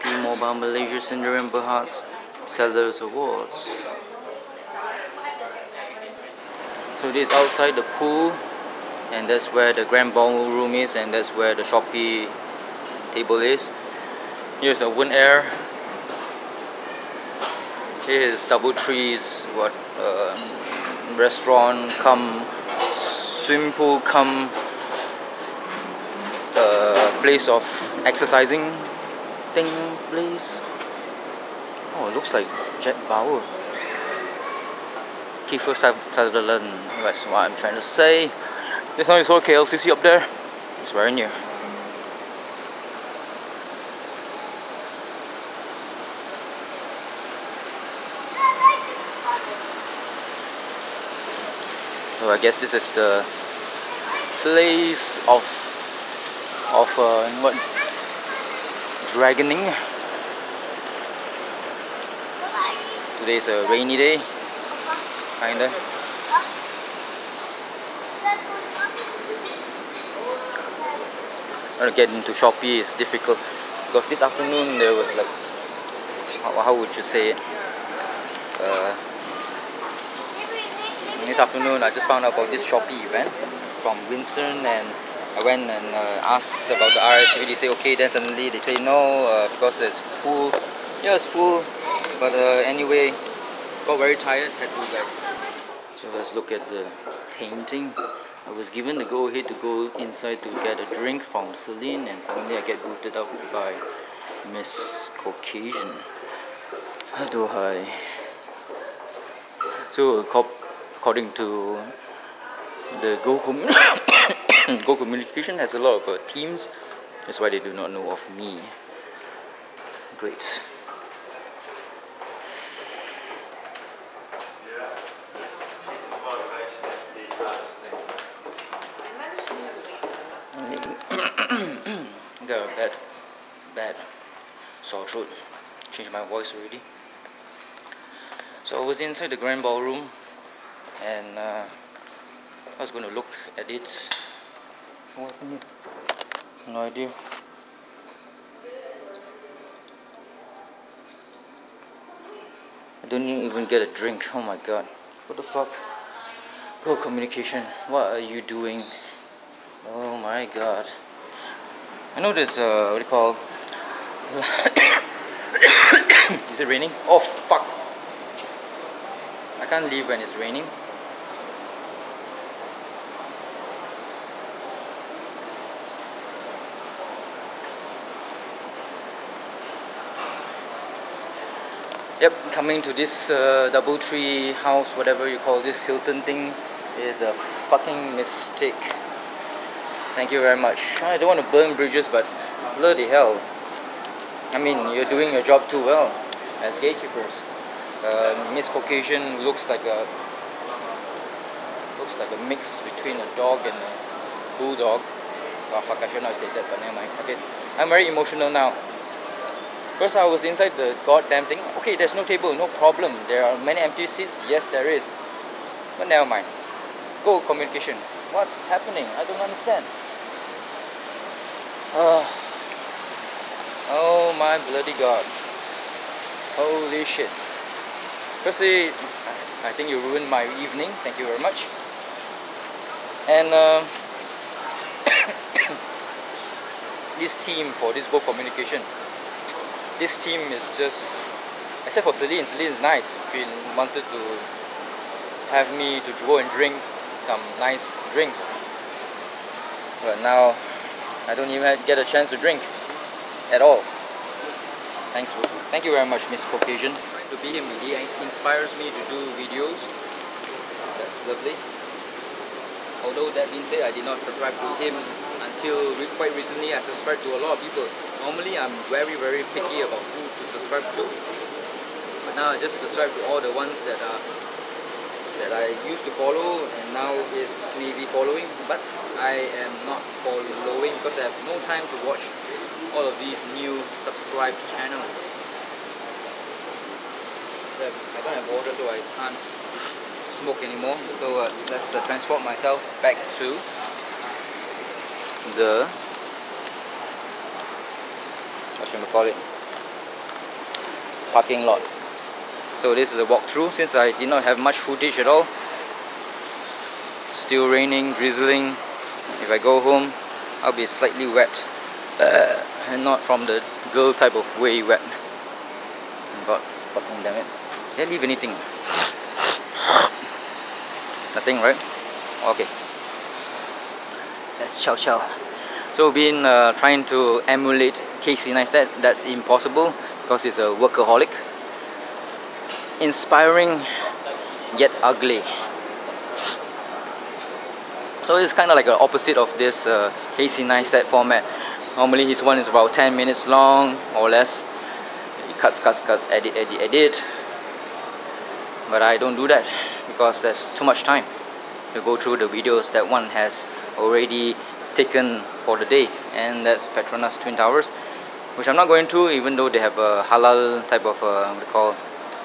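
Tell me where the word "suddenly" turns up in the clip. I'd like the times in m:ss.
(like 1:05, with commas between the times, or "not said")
1:28, 1:42.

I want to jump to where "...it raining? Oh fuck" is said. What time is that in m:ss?
2:46.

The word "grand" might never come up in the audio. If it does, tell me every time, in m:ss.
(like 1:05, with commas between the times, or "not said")
0:09, 2:19.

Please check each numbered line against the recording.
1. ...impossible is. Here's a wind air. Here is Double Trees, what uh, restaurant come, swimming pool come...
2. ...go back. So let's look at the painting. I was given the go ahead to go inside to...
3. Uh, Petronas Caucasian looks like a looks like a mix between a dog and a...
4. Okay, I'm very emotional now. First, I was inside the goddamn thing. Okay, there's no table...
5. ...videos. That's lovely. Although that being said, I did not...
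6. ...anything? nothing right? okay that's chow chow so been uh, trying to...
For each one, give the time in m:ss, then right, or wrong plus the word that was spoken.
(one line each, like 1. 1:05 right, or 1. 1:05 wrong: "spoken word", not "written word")
1. 0:13 wrong: "table", not "impossible"
2. 1:34 right
3. 3:18 wrong: "Miss", not "Petronas"
4. 3:27 right
5. 4:19 right
6. 5:18 right.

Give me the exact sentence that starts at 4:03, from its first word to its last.
She wanted to have me to go and drink some nice drinks.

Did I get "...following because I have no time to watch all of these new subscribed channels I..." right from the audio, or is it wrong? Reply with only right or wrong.
right.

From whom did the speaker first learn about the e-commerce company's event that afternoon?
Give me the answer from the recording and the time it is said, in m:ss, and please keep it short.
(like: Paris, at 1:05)
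Winston, at 1:24.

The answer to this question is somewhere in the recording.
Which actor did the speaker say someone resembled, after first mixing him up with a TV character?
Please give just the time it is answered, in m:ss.
0:35.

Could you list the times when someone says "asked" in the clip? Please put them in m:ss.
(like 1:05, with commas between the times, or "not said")
1:26.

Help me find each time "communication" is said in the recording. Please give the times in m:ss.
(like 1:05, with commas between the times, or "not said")
1:54, 2:36, 3:37, 3:58.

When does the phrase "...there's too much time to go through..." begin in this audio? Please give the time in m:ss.
5:50.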